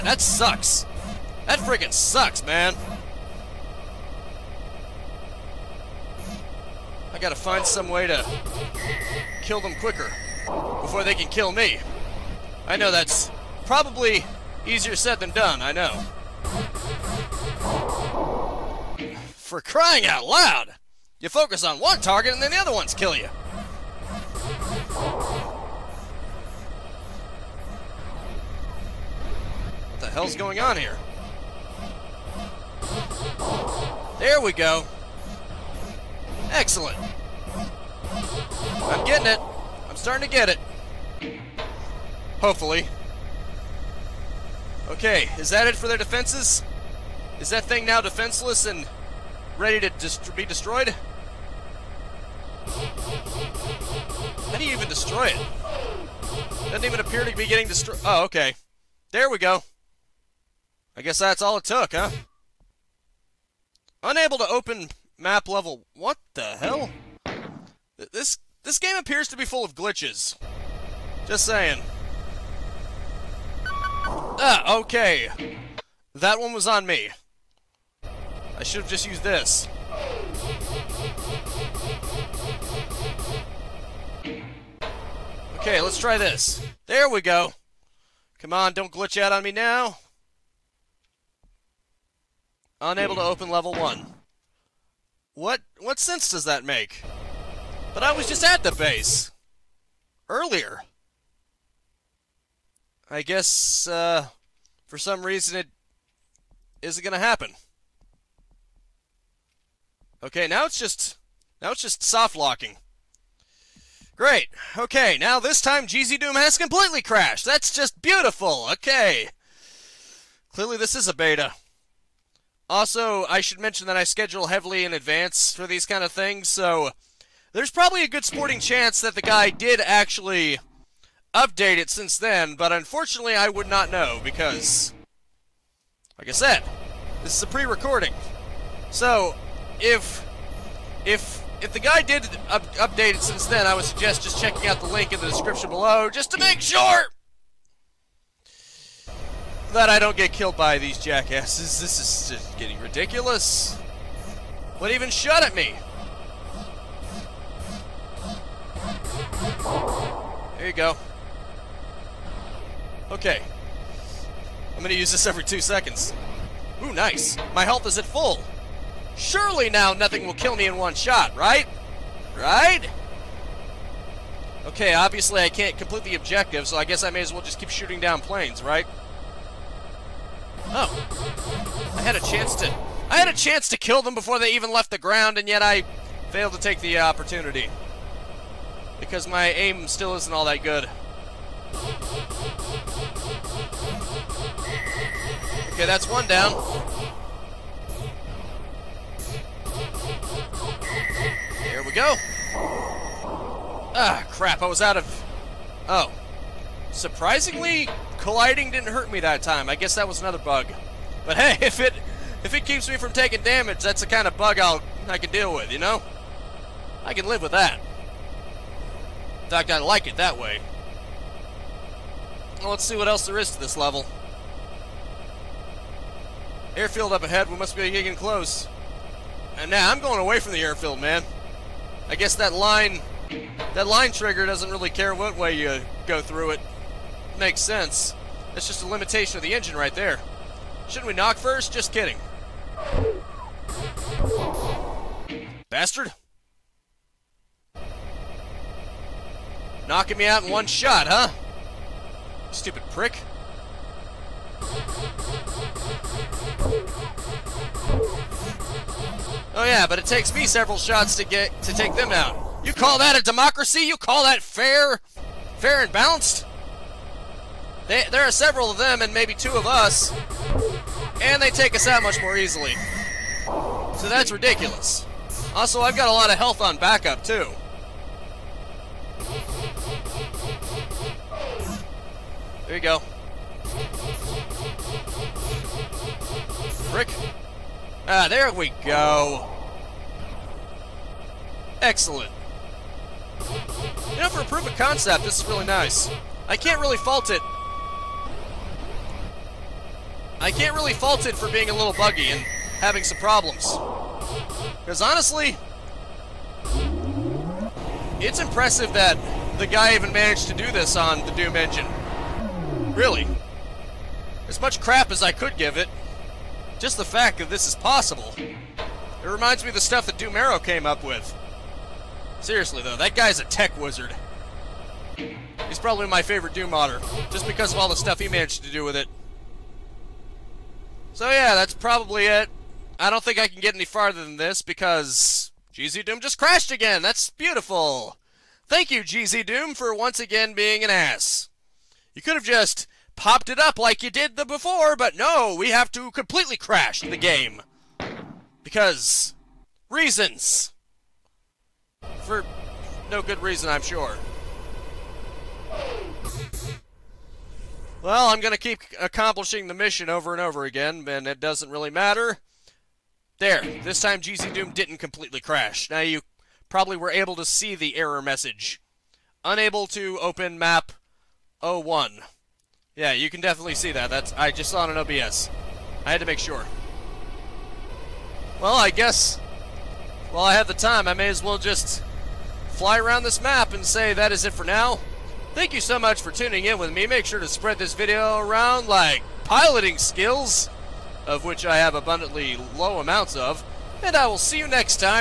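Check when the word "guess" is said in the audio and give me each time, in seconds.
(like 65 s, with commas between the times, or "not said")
61 s, 103 s, 176 s, 209 s, 232 s, 378 s.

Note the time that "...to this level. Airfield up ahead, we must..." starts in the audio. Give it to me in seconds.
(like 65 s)
223 s.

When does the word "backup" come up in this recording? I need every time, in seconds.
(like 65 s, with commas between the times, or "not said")
276 s.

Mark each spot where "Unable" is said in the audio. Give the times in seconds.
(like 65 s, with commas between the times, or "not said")
64 s, 92 s, 369 s.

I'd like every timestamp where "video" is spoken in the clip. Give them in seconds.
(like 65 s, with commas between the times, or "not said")
387 s.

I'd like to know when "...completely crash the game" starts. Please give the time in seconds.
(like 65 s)
346 s.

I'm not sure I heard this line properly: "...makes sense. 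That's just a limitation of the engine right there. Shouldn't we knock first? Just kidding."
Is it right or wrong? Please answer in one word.
right.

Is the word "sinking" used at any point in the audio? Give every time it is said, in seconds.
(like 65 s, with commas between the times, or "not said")
not said.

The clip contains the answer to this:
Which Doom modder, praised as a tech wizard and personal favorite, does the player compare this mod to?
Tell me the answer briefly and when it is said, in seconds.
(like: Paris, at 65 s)
Doom Arrow, at 320 s.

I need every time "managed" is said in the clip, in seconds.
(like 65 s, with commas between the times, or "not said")
310 s, 328 s.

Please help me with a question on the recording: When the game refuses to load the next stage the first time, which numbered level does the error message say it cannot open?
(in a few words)
Level 1.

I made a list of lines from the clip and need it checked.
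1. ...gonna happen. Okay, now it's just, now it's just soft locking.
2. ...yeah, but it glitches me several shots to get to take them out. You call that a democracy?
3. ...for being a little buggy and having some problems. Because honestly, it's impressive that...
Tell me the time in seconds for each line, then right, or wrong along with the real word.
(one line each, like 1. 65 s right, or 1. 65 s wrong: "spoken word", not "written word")
1. 107 s right
2. 259 s wrong: "takes", not "glitches"
3. 301 s right.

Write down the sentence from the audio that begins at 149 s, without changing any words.
That I don't get killed by these jackasses.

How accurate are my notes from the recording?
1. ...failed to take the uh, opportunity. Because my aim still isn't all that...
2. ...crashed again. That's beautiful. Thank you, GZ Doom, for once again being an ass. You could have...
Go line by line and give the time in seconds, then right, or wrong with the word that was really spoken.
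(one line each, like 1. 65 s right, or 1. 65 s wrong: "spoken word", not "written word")
1. 186 s right
2. 336 s right.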